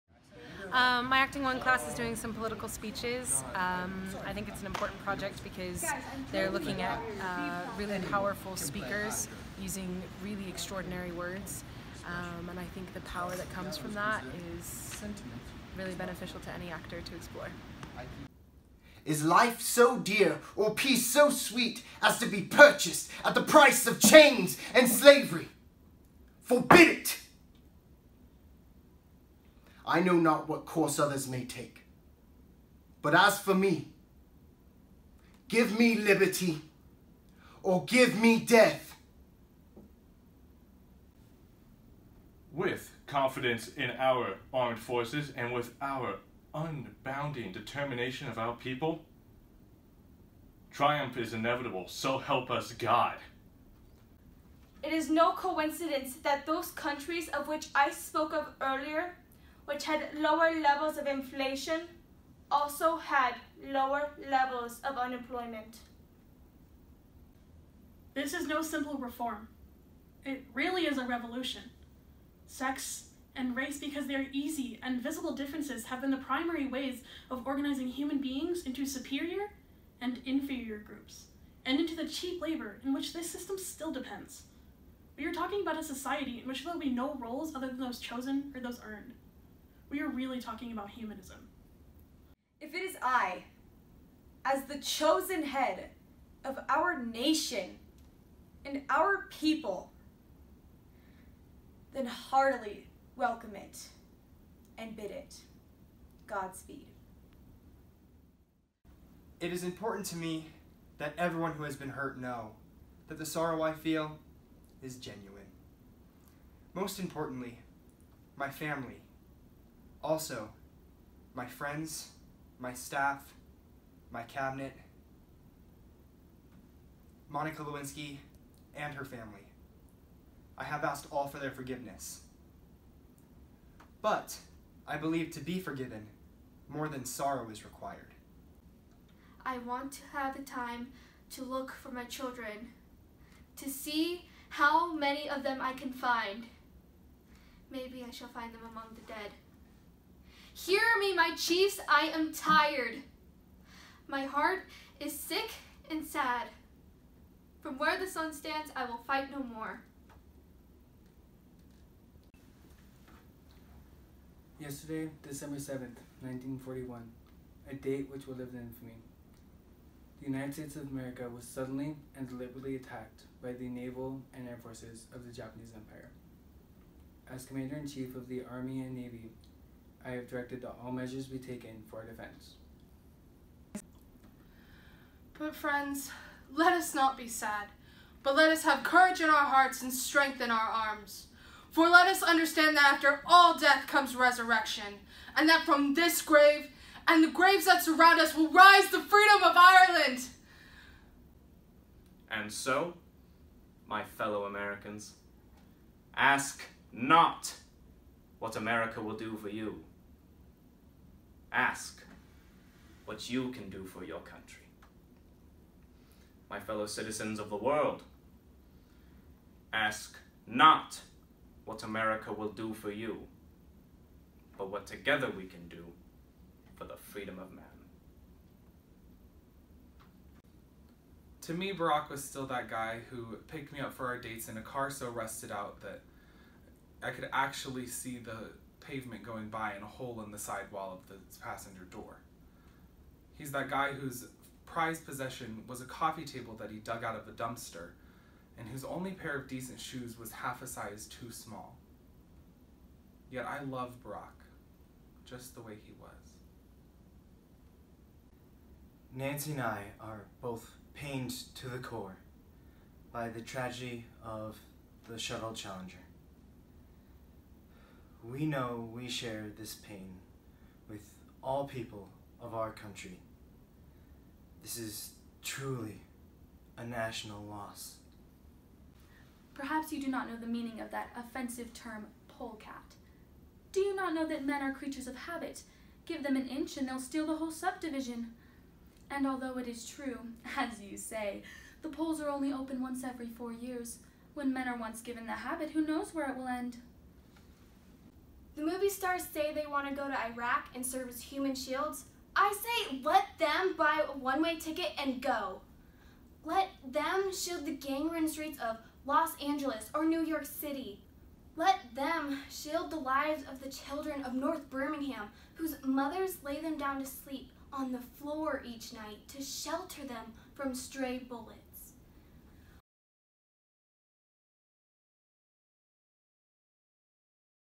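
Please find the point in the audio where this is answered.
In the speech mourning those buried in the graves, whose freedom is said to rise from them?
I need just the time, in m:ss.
3:19.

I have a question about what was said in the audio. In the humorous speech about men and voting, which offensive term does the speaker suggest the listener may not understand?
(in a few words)
Polecat.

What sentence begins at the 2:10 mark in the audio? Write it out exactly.
I have asked all for their forgiveness.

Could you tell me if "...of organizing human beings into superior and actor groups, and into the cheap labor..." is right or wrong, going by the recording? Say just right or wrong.
wrong.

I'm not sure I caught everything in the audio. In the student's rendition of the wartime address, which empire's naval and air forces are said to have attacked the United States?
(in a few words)
Japanese Empire.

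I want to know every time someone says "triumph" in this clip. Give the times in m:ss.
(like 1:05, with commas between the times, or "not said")
0:50.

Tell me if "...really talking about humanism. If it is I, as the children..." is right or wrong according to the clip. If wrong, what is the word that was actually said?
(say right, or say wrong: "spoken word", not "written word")
wrong: "chosen", not "children".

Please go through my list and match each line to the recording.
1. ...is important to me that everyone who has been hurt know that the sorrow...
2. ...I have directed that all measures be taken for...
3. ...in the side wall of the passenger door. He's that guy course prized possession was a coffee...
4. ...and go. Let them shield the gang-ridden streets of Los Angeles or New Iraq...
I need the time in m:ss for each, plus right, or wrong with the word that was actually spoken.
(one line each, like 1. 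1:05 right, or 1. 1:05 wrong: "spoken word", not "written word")
1. 1:49 right
2. 3:00 right
3. 4:00 wrong: "whose", not "course"
4. 5:04 wrong: "York", not "Iraq".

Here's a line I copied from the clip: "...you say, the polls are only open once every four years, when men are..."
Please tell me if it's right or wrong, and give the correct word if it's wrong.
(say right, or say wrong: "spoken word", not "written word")
right.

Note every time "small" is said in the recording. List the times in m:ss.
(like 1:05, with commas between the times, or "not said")
4:11.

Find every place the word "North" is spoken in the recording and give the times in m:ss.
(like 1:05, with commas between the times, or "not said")
5:14.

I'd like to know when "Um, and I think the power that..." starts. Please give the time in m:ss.
0:12.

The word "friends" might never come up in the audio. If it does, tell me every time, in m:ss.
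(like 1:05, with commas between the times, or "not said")
2:01, 3:05.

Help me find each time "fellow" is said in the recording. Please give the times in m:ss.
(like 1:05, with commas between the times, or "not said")
3:24, 3:36.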